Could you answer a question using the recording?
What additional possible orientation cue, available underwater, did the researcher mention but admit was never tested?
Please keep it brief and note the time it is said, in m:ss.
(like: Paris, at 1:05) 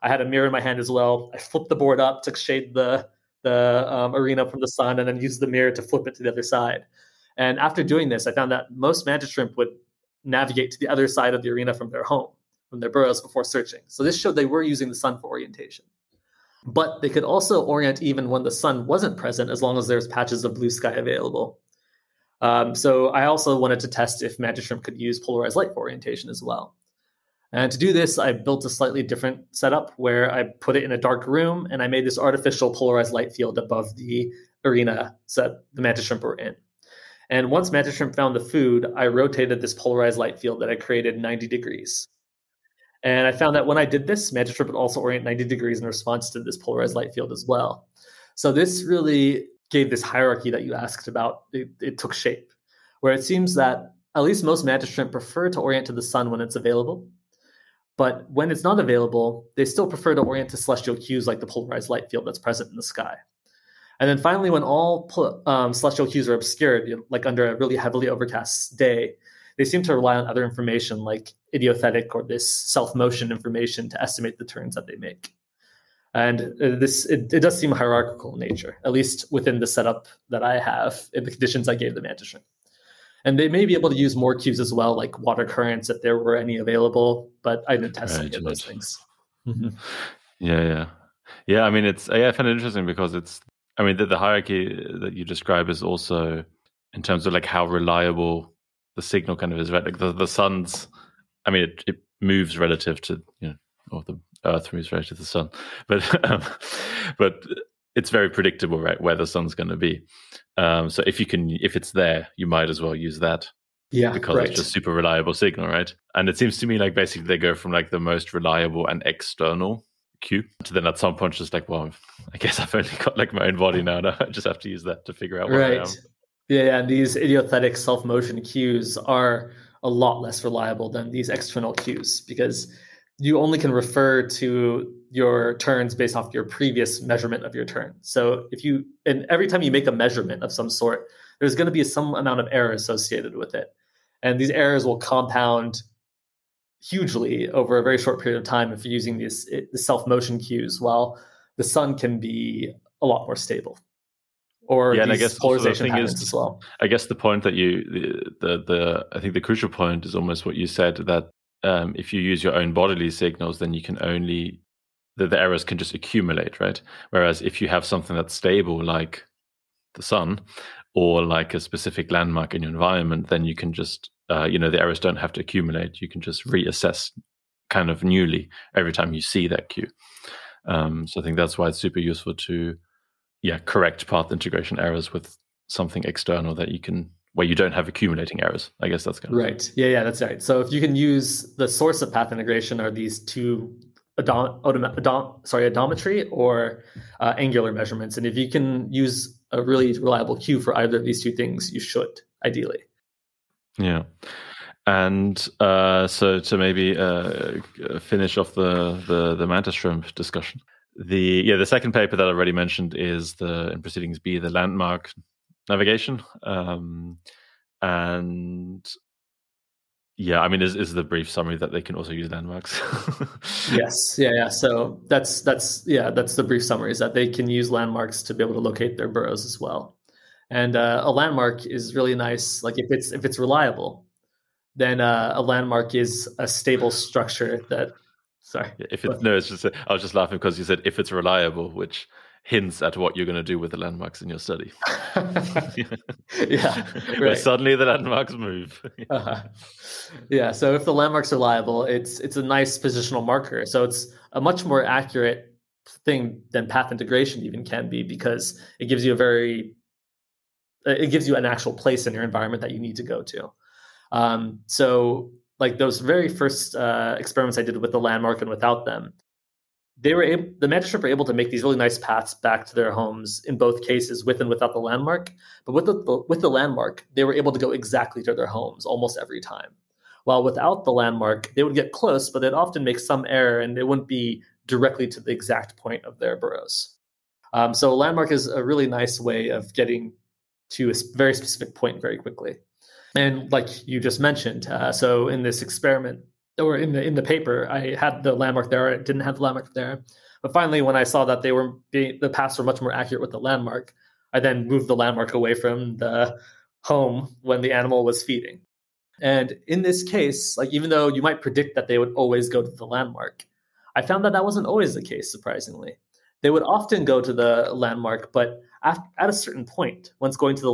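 water currents, at 1:25.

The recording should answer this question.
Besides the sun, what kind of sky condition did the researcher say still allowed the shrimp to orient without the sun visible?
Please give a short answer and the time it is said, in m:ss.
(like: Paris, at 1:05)
patches of blue sky, at 0:20.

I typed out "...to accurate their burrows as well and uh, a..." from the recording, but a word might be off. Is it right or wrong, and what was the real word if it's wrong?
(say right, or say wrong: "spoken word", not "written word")
wrong: "locate", not "accurate".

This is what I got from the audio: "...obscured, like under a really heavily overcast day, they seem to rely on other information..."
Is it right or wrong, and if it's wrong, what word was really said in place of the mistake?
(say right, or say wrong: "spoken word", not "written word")
right.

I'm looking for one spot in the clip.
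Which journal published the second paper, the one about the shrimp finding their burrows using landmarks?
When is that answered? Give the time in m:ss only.
3:33.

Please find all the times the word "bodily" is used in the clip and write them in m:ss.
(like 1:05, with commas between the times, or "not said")
2:42.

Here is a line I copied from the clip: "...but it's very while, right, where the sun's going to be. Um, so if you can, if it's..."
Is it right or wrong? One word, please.
wrong.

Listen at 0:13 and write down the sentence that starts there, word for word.
So this showed they were using the sun for orientation.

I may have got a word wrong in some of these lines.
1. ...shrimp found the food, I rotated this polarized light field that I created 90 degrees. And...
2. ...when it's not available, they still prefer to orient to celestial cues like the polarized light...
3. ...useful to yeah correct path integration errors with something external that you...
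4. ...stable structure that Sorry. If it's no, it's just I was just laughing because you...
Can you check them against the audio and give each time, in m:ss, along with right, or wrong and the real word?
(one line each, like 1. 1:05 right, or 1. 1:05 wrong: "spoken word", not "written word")
1. 0:37 right
2. 0:58 right
3. 3:02 right
4. 3:56 right.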